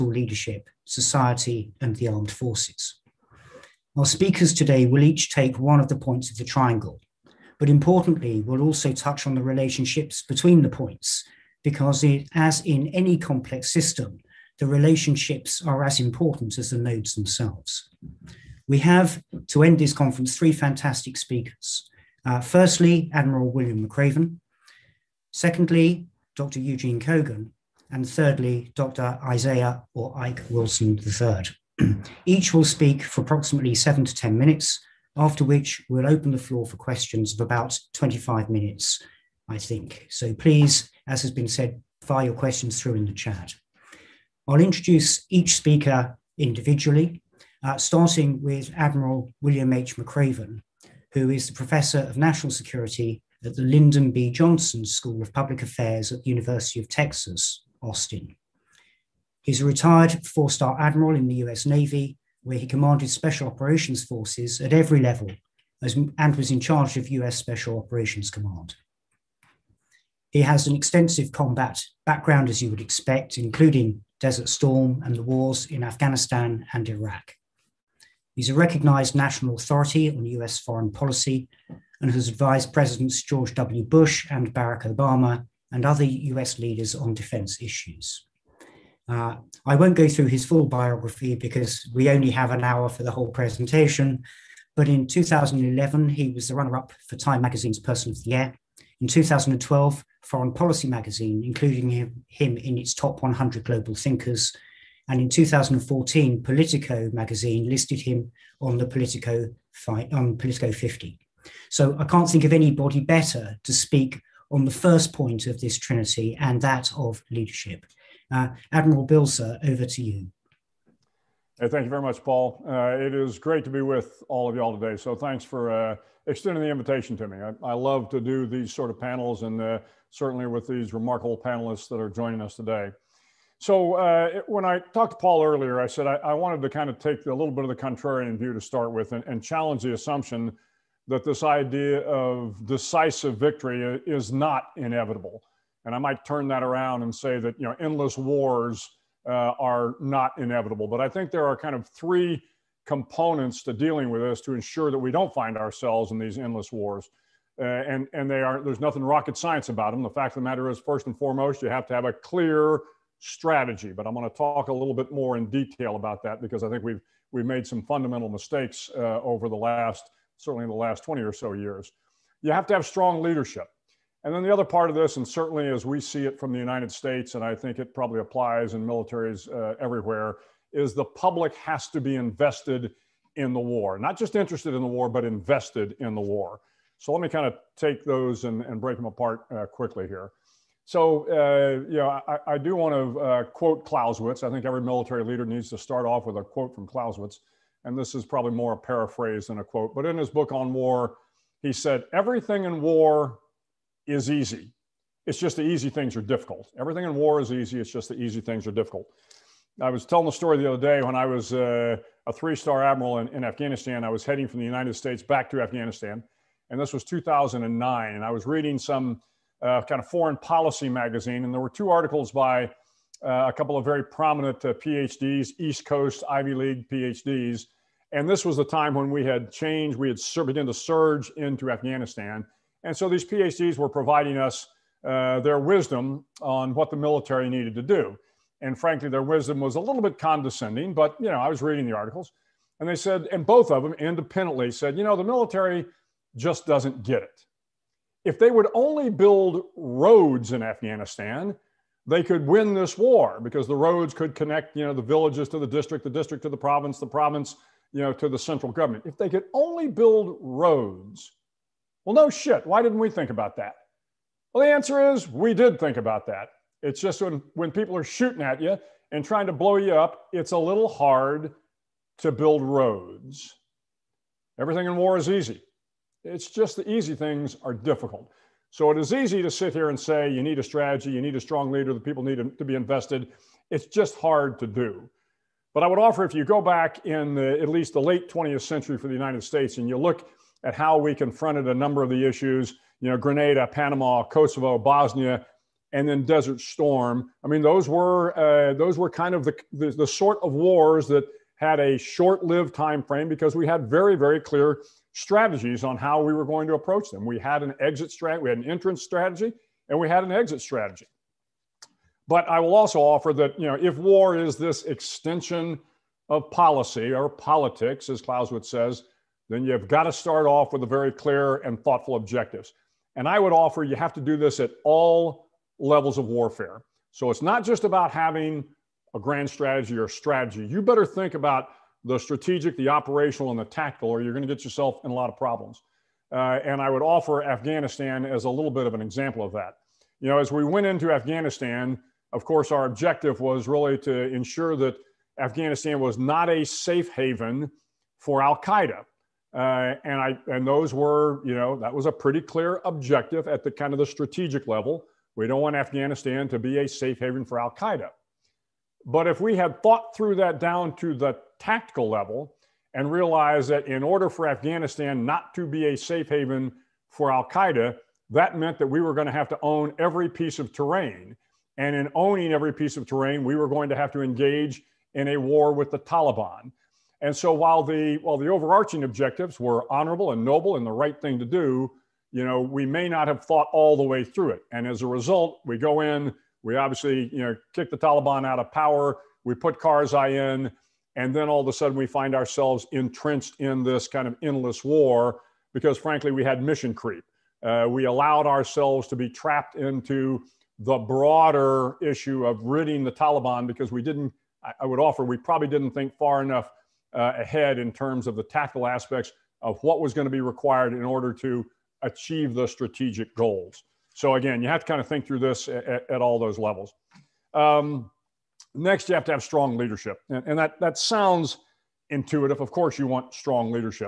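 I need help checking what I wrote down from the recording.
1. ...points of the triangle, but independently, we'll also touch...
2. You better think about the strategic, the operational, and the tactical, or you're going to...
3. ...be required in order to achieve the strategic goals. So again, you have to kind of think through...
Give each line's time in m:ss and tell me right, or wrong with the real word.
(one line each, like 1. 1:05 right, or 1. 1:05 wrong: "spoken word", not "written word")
1. 0:05 wrong: "importantly", not "independently"
2. 5:30 right
3. 6:50 right.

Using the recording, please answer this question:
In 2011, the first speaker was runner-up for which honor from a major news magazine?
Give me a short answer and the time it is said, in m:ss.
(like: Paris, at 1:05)
Time Magazine's Person of the Year, at 1:37.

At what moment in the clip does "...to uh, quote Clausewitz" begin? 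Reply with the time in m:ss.
3:12.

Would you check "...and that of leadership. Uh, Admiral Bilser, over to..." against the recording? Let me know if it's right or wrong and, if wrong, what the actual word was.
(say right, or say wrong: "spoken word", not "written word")
right.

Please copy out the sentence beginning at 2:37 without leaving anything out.
Uh, and and they are there's nothing rocket science about them.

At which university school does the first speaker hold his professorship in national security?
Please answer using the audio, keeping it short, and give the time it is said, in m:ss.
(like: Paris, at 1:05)
Lyndon B. Johnson School of Public Affairs, at 0:53.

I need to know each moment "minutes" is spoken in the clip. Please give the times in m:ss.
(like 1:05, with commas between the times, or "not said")
0:34, 0:38.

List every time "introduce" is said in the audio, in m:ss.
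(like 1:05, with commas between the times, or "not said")
0:44.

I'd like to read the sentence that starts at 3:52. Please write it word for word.
And so these PhDs were providing us uh, their wisdom on what the military needed to do.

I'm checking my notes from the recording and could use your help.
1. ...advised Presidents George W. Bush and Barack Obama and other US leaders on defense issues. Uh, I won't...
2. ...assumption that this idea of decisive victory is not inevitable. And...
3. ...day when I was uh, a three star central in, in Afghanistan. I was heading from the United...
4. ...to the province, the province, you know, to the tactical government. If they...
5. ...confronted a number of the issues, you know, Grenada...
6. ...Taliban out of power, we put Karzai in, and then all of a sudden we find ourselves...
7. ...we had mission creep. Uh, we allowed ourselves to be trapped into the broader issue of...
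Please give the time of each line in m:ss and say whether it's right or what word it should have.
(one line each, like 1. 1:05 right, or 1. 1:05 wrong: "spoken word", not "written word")
1. 1:22 right
2. 2:19 right
3. 3:30 wrong: "admiral", not "central"
4. 4:16 wrong: "central", not "tactical"
5. 4:51 right
6. 6:27 right
7. 6:36 right.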